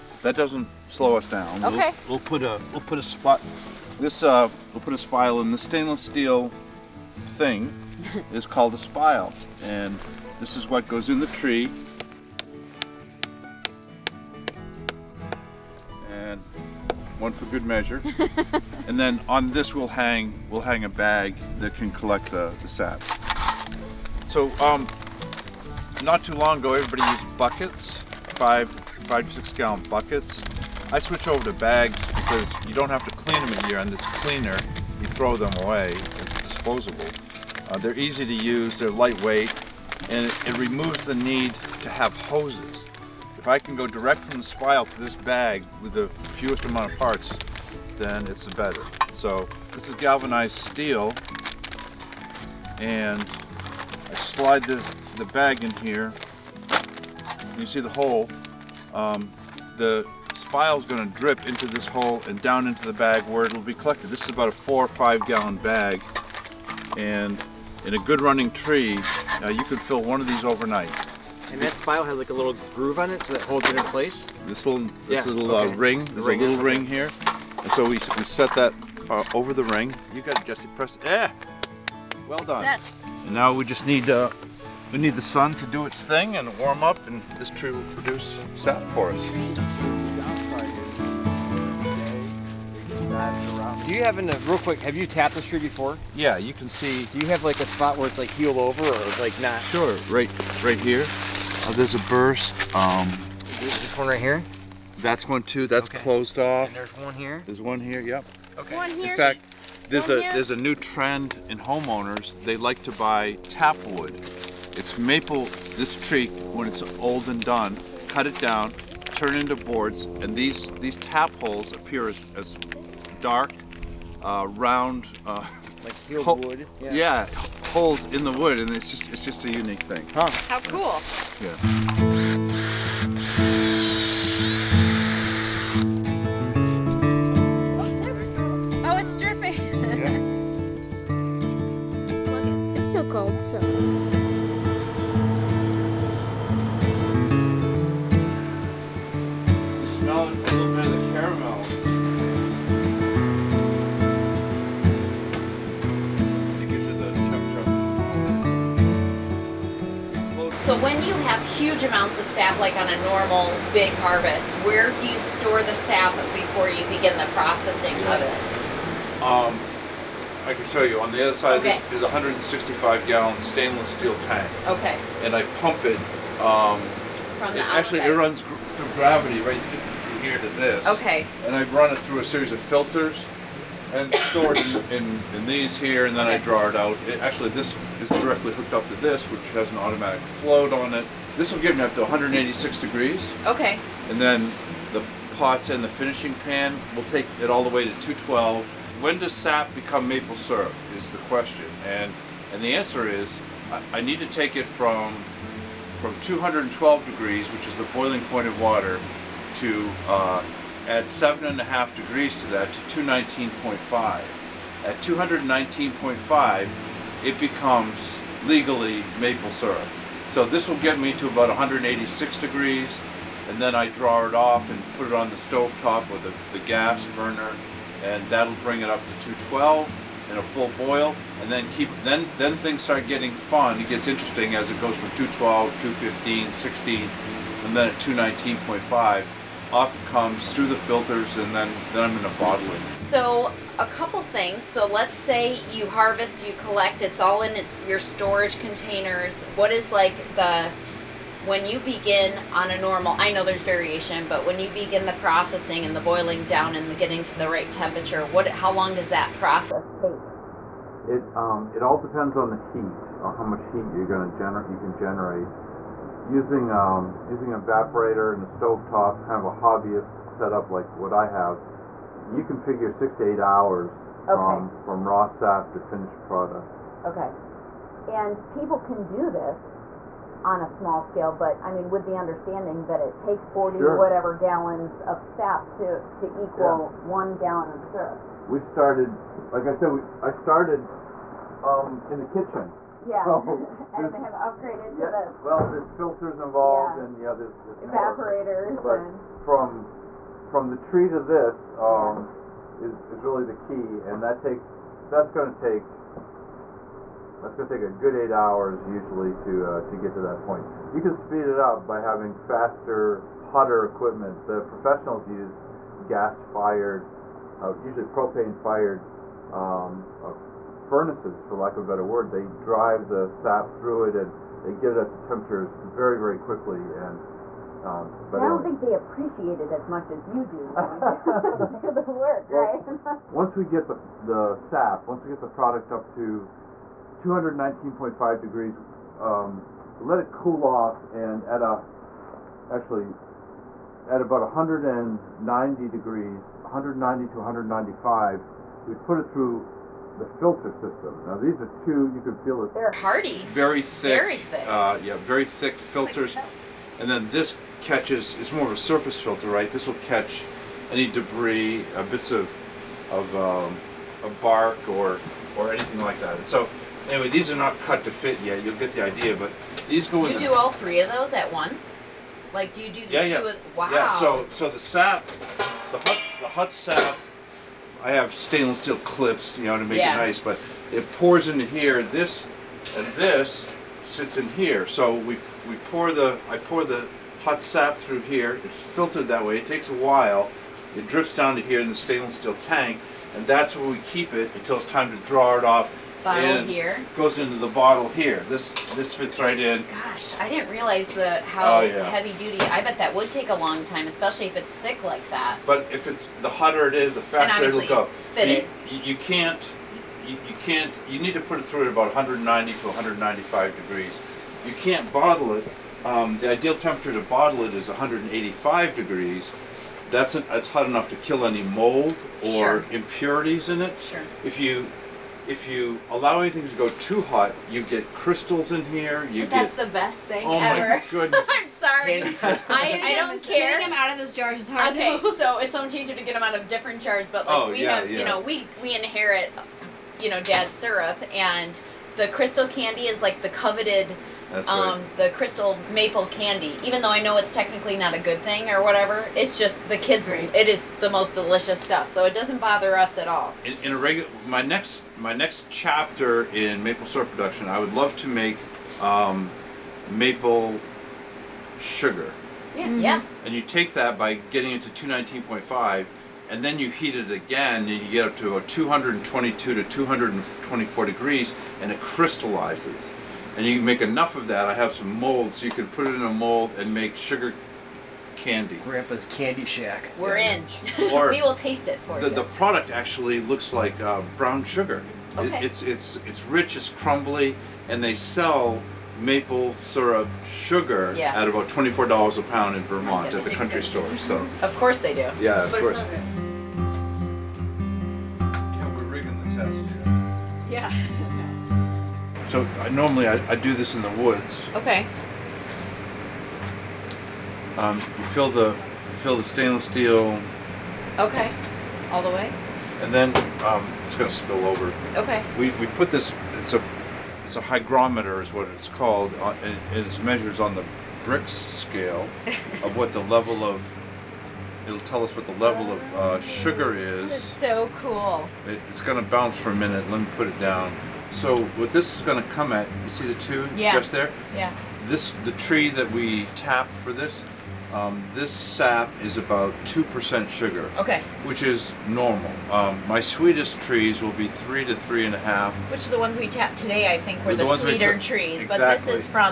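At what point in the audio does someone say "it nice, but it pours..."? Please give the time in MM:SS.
06:20.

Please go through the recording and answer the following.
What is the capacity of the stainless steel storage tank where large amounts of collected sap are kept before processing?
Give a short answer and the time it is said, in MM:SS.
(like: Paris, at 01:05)
165 gallons, at 02:52.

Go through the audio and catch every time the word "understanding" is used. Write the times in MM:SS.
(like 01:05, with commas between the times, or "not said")
04:42.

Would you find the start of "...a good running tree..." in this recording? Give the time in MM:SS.
01:07.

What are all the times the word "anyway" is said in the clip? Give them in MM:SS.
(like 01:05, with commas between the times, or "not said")
05:28, 06:07.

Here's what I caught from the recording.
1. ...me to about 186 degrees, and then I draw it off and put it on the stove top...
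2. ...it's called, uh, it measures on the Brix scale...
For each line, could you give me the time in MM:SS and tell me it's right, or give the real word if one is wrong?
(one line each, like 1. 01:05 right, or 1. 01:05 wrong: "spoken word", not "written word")
1. 03:40 right
2. 08:38 right.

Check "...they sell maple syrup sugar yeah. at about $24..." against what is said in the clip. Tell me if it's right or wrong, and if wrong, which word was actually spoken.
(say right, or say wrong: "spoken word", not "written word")
right.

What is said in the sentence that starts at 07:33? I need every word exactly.
In, in a regular, my next my next chapter in maple syrup production, I would love to make um, maple sugar.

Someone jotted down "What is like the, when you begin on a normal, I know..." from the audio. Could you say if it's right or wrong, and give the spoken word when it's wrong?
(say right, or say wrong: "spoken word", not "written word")
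right.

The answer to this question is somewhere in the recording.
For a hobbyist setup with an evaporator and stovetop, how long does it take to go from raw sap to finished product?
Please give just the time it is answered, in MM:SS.
04:32.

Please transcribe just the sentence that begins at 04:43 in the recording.
whatever gallons of sap to, to equal yeah.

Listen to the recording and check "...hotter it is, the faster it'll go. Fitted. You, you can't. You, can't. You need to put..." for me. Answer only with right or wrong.
right.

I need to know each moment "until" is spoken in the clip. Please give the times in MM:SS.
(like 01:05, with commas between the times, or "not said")
06:34.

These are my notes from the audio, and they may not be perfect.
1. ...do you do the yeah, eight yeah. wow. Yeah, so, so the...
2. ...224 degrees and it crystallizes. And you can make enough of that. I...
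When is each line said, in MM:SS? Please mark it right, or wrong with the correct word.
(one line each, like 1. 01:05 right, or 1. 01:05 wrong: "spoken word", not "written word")
1. 06:12 wrong: "two", not "eight"
2. 07:50 right.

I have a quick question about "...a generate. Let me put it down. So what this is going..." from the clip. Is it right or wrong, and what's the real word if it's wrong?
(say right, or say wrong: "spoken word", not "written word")
wrong: "minute", not "generate".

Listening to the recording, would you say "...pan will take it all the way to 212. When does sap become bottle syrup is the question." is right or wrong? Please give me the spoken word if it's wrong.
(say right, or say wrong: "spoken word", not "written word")
wrong: "maple", not "bottle".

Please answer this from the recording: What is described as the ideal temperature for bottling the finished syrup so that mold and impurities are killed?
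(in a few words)
185 degrees.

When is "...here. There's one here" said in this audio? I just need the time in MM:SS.
01:47.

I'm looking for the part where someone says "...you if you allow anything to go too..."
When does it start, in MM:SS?
07:04.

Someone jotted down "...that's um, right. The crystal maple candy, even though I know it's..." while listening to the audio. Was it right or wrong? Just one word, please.
right.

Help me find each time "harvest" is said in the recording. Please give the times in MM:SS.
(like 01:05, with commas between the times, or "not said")
02:44, 04:05.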